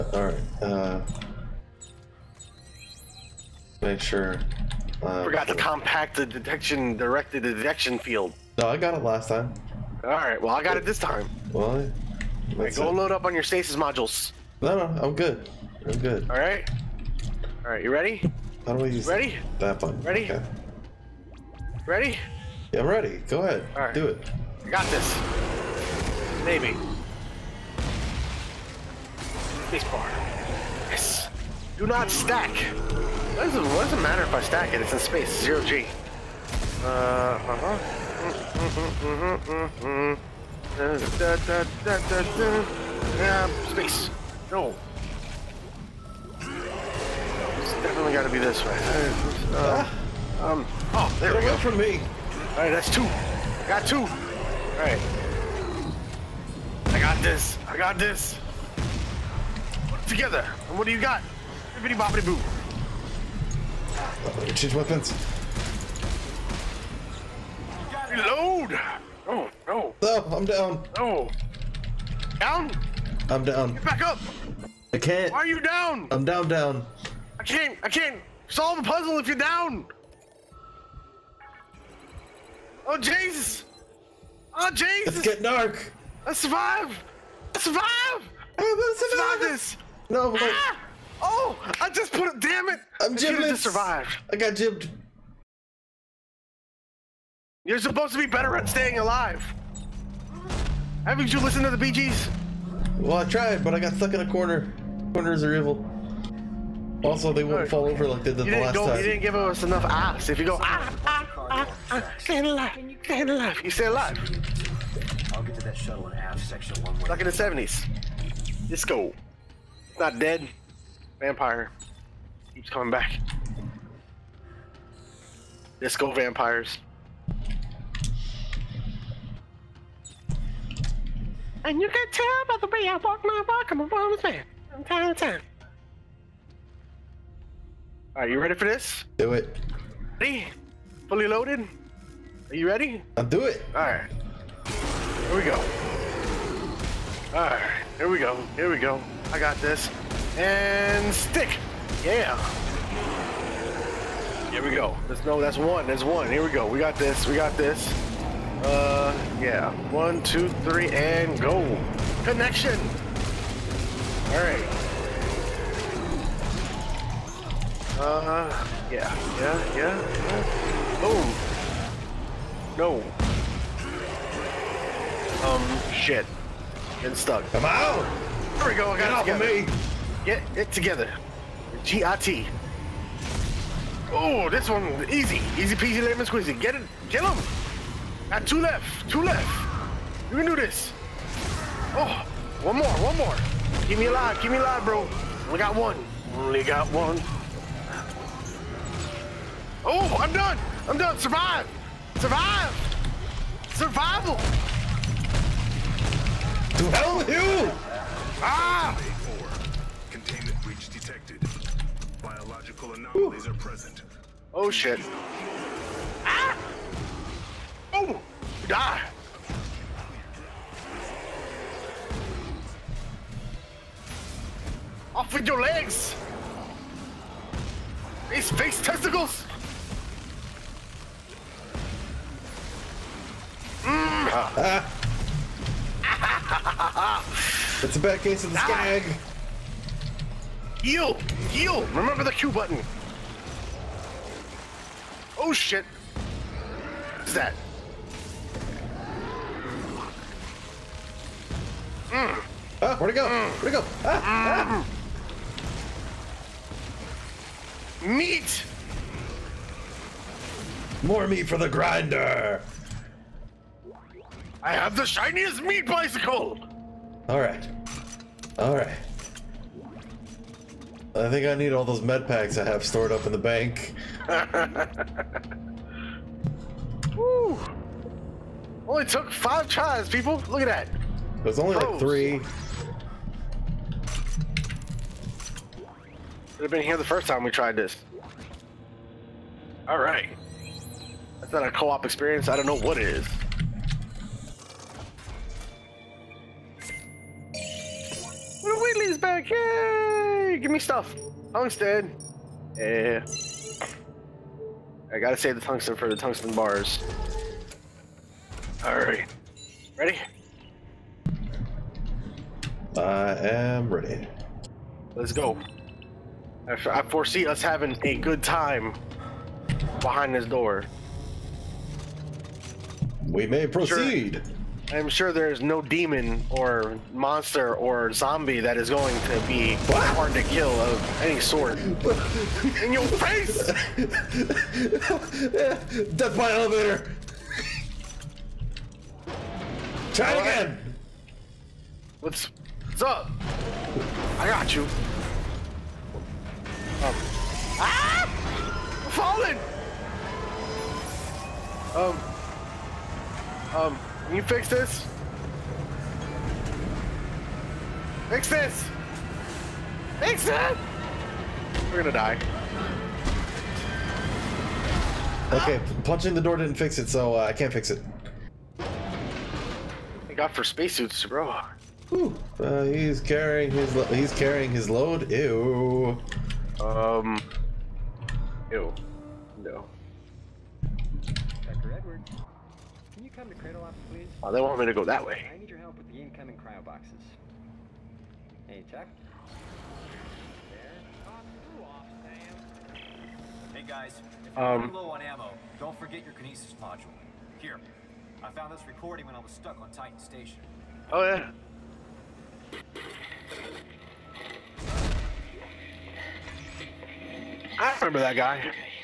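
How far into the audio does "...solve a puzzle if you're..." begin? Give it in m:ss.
1:18.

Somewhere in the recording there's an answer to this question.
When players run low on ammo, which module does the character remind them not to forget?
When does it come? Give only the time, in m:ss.
6:36.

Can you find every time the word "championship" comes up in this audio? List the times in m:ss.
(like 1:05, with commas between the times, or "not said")
not said.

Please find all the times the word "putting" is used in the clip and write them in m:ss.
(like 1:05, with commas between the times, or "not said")
not said.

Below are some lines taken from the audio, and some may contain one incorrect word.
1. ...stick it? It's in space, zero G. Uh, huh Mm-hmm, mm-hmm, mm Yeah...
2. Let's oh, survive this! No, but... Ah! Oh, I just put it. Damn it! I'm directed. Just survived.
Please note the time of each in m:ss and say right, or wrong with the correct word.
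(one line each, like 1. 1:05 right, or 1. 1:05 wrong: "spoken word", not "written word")
1. 0:34 wrong: "stack", not "stick"
2. 1:28 wrong: "gibbed", not "directed".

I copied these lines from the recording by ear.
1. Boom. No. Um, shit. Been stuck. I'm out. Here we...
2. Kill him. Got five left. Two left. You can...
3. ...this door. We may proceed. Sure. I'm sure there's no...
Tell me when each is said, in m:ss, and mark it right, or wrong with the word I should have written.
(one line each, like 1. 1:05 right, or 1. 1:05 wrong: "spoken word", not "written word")
1. 2:51 right
2. 3:07 wrong: "two", not "five"
3. 5:20 right.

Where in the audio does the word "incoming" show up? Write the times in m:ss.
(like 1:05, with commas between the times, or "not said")
6:26.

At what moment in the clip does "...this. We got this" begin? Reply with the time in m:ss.
2:36.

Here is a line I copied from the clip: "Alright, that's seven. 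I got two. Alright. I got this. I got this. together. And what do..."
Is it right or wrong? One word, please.
wrong.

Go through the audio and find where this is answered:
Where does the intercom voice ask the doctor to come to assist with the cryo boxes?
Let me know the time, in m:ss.
6:23.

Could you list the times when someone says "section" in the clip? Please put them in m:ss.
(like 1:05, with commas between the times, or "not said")
1:56.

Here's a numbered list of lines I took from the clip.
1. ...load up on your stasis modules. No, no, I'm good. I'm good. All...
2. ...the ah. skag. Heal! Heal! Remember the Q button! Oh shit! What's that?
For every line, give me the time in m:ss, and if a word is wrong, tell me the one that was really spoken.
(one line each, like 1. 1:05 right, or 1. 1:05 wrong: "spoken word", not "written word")
1. 0:12 right
2. 3:58 right.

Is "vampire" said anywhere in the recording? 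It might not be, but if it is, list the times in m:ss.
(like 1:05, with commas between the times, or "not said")
2:01, 2:06.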